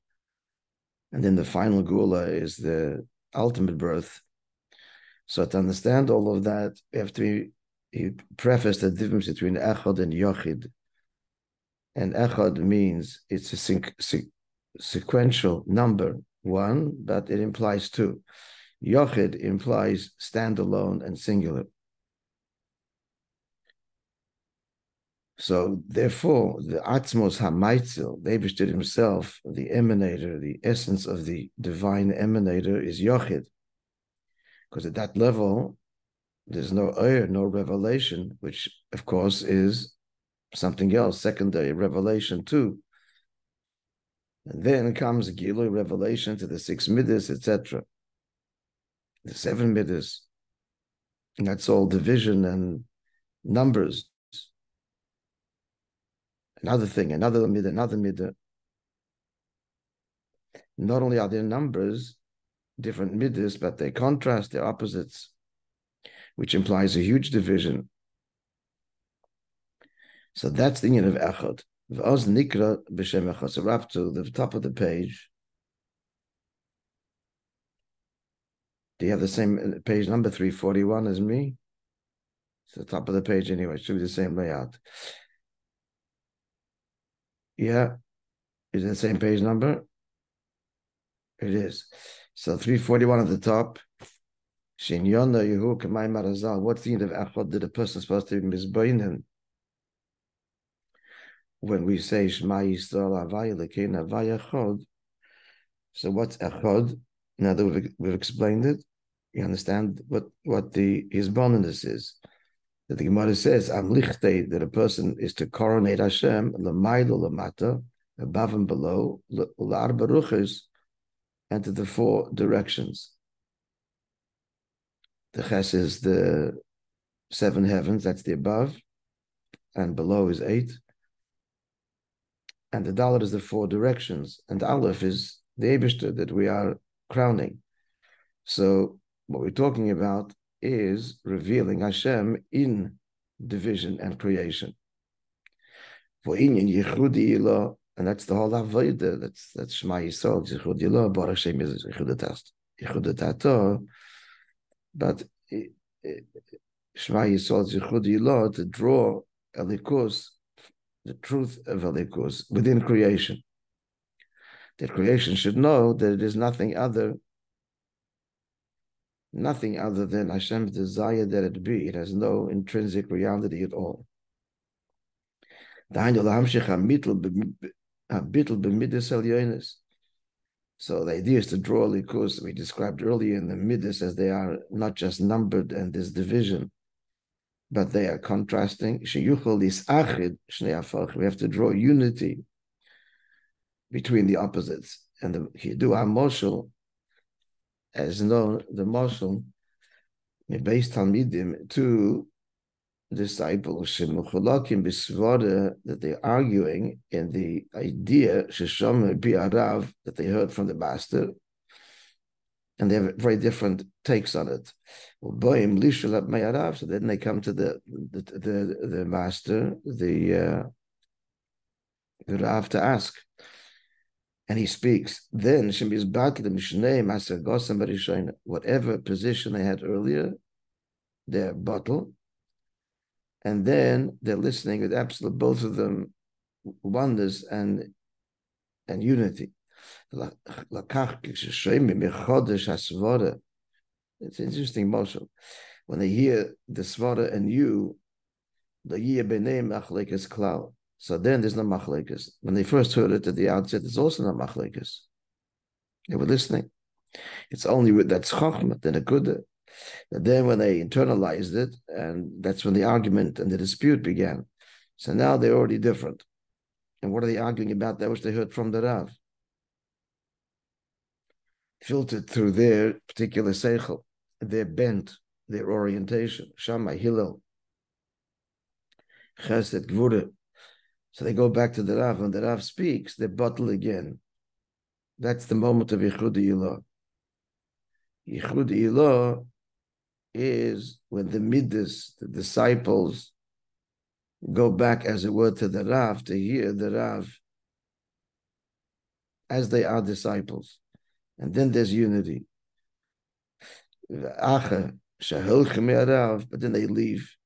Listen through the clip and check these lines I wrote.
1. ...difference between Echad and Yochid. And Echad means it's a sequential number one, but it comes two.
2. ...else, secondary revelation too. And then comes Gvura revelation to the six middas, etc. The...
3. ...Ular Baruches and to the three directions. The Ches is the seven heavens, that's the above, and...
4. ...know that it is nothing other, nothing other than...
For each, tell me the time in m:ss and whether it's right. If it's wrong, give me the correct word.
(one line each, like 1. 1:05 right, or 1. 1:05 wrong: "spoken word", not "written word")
1. 0:08 wrong: "implies", not "comes"
2. 0:40 wrong: "Gilu", not "Gvura"
3. 1:59 wrong: "four", not "three"
4. 2:45 right.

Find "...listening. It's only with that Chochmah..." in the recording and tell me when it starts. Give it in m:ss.
4:16.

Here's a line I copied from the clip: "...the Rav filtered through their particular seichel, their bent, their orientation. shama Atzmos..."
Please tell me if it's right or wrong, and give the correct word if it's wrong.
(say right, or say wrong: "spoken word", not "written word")
wrong: "Hillel", not "Atzmos".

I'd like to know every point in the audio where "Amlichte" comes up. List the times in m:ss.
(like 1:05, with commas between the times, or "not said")
1:53.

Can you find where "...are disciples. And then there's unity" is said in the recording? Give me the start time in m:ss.
4:59.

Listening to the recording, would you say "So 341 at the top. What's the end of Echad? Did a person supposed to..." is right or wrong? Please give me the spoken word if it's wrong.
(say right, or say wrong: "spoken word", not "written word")
right.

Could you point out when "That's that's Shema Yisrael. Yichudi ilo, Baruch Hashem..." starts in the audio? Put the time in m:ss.
2:29.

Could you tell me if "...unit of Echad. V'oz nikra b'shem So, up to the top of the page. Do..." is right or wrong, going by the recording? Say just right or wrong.
right.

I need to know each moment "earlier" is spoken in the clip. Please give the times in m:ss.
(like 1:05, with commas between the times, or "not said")
3:03, 3:49.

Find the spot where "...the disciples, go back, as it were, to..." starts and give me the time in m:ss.
4:52.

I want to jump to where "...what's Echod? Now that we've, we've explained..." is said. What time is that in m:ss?
1:46.